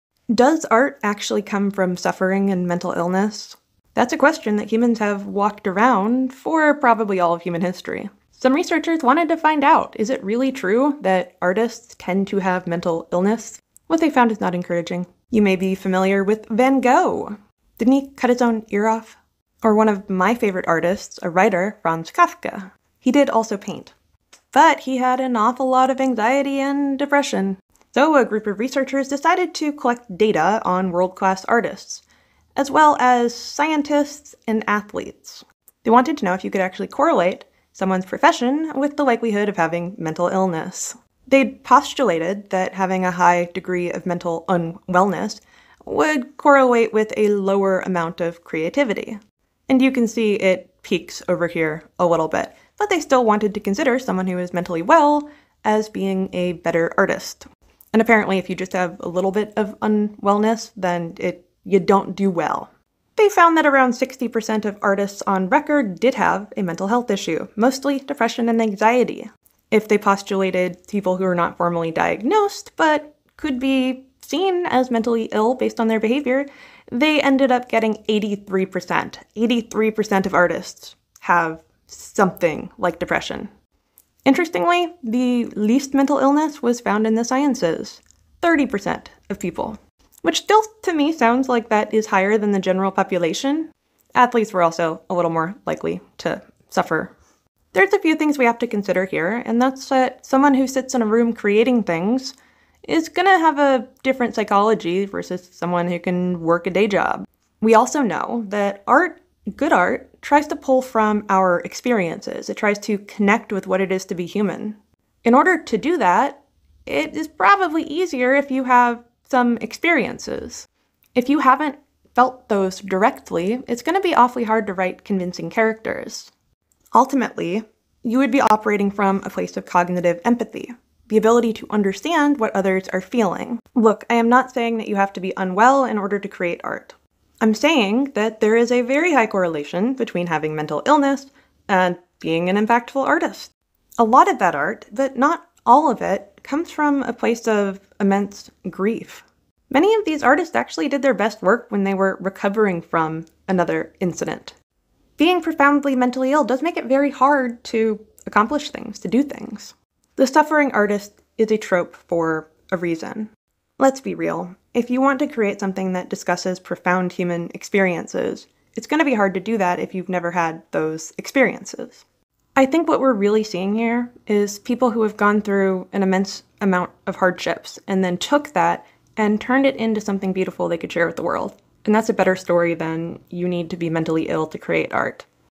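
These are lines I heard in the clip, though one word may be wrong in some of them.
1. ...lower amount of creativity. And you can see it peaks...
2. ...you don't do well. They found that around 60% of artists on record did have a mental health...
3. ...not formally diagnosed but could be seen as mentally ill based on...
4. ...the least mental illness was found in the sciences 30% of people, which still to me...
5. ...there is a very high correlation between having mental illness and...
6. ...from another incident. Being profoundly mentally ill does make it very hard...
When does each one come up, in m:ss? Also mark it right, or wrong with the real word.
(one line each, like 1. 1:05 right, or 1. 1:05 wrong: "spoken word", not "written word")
1. 0:47 right
2. 1:01 right
3. 1:11 right
4. 1:25 right
5. 2:18 right
6. 2:32 right.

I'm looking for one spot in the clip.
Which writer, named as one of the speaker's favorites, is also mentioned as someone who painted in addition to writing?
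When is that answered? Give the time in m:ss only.
0:21.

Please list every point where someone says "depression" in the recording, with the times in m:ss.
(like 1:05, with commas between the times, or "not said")
0:26, 1:07, 1:22.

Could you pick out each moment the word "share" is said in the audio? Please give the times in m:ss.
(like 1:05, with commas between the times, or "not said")
3:00.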